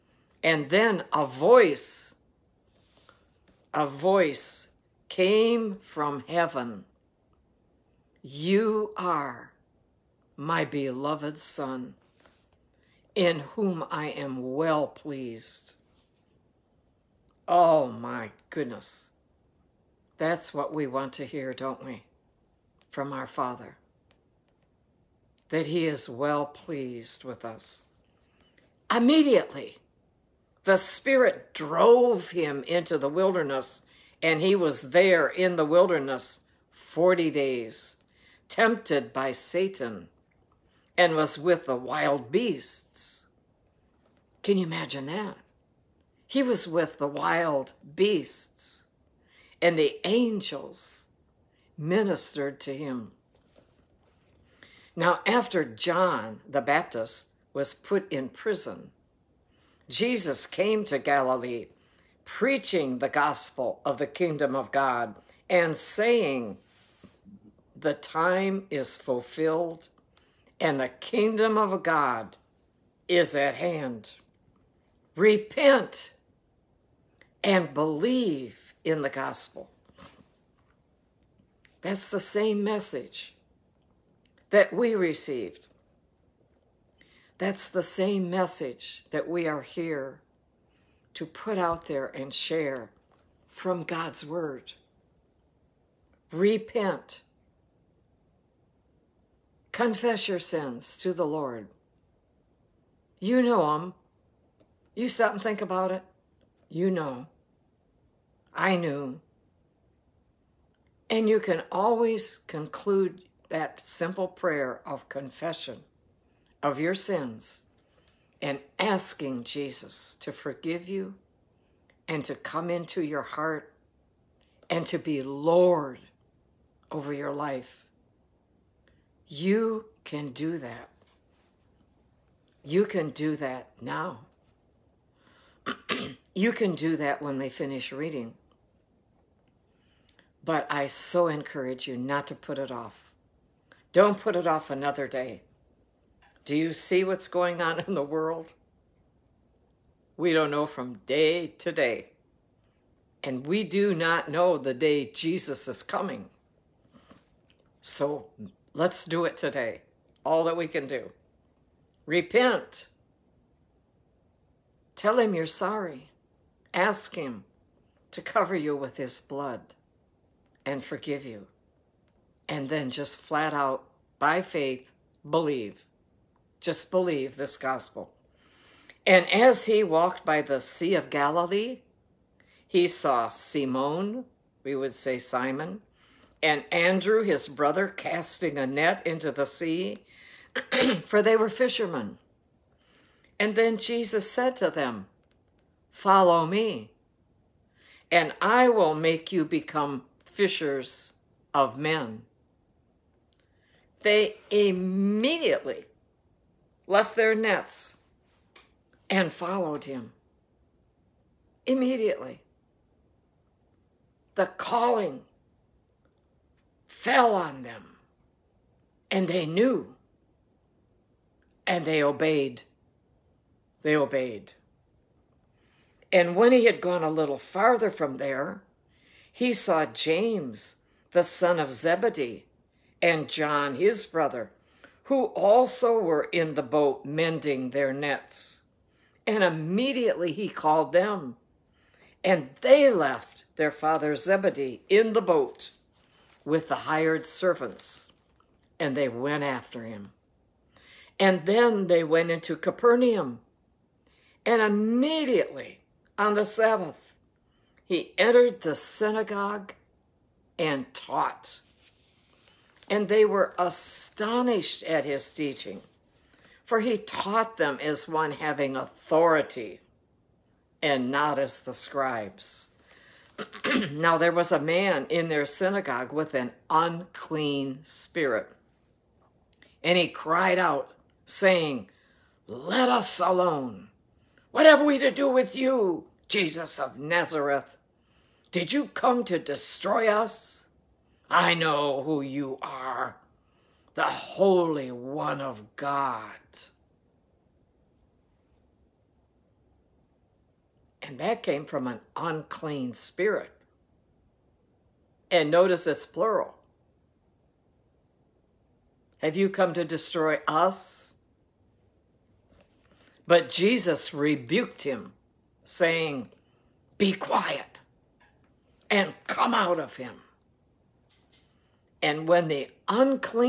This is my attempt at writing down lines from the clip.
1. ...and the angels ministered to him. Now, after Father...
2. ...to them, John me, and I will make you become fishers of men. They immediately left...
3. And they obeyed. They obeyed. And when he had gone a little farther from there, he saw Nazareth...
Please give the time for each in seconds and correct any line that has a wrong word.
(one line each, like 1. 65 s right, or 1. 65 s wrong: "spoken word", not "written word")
1. 49 s wrong: "John", not "Father"
2. 194 s wrong: "Follow", not "John"
3. 221 s wrong: "James", not "Nazareth".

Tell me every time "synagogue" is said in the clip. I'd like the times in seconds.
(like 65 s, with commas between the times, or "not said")
258 s, 275 s.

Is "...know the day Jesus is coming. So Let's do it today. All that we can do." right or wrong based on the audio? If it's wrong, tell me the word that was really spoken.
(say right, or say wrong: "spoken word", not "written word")
right.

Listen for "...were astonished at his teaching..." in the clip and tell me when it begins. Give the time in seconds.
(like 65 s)
263 s.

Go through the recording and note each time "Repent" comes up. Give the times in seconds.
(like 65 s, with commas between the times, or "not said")
75 s, 96 s, 162 s.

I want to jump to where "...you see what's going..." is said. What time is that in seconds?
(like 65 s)
146 s.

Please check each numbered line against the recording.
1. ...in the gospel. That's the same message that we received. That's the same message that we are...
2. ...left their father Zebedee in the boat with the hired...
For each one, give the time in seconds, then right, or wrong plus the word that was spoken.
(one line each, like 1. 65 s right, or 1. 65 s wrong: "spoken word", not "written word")
1. 78 s right
2. 242 s right.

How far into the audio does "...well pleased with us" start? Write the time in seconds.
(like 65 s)
26 s.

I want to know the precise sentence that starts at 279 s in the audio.
And he cried out, saying, Let us alone.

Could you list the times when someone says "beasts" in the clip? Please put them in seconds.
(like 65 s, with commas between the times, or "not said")
42 s, 47 s.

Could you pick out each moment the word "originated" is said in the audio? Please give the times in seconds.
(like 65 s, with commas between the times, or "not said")
not said.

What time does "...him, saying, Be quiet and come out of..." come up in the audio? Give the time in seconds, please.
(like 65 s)
314 s.